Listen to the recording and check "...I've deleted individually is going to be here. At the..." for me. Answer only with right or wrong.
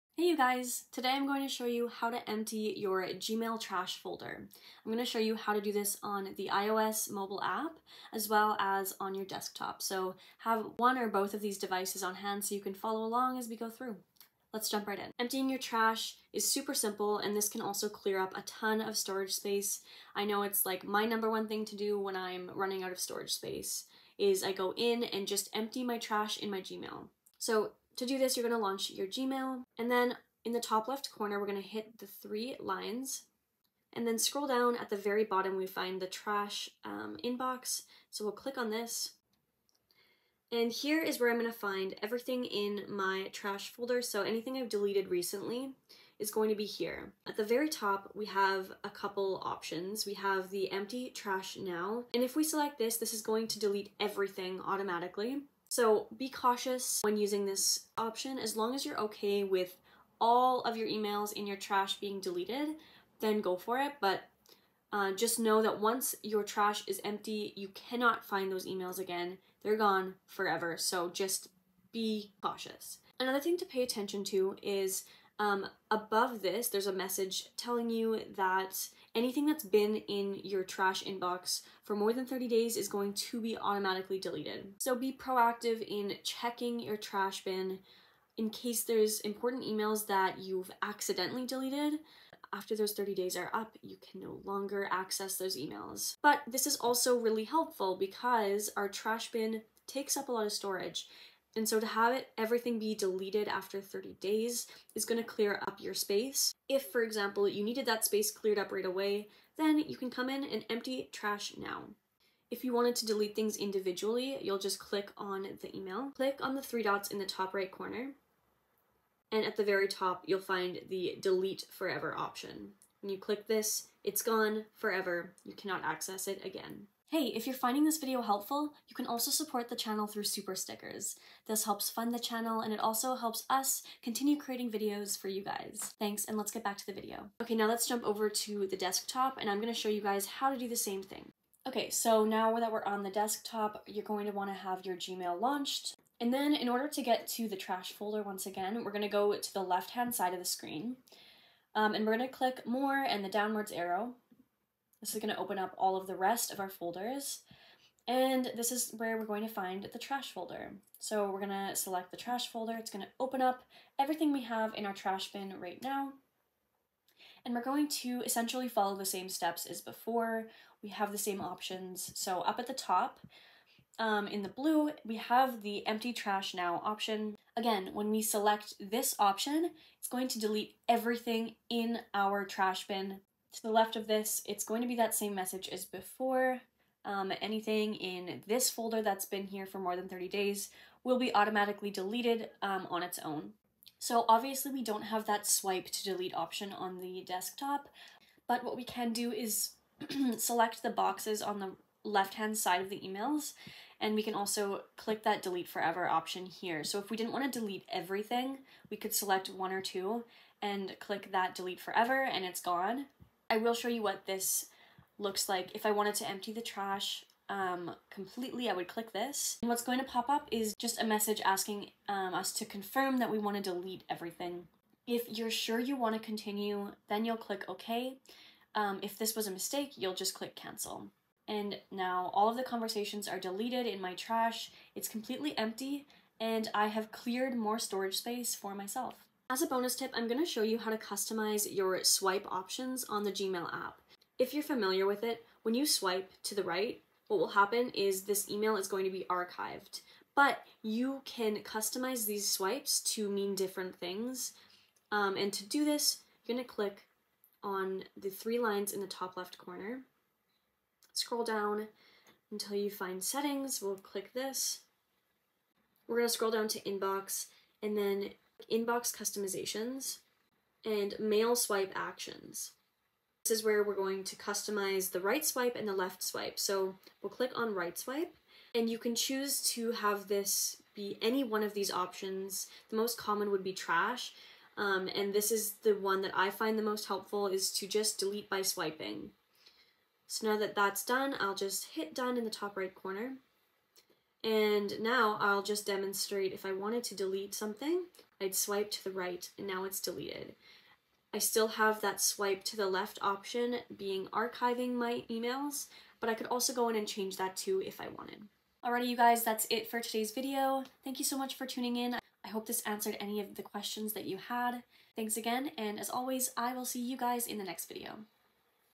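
wrong.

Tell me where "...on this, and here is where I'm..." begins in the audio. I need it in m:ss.
0:38.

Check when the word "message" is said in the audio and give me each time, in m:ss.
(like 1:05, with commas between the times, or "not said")
1:16, 3:05, 3:41.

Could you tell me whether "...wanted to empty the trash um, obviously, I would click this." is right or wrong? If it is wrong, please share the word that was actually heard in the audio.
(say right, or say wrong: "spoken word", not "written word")
wrong: "completely", not "obviously".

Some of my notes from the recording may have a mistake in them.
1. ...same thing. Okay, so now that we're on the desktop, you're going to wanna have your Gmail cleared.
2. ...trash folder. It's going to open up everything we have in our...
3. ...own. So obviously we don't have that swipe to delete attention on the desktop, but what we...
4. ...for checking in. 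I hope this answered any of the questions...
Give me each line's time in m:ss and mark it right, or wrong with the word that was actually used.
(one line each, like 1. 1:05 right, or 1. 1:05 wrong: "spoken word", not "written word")
1. 2:20 wrong: "launched", not "cleared"
2. 2:42 right
3. 3:13 wrong: "option", not "attention"
4. 5:11 wrong: "tuning", not "checking".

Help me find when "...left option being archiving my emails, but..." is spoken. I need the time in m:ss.
5:02.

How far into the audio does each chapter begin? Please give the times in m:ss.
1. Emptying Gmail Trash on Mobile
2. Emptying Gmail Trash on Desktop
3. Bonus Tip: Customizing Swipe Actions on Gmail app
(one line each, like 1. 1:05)
1. 0:14
2. 2:17
3. 3:59.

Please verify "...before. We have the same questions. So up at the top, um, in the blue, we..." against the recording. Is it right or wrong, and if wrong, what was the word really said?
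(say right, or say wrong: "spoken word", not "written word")
wrong: "options", not "questions".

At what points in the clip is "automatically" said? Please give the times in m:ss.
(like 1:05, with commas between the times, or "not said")
0:54, 1:23, 3:11.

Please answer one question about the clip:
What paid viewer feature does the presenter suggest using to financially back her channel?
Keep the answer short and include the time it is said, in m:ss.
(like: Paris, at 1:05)
Super stickers, at 2:10.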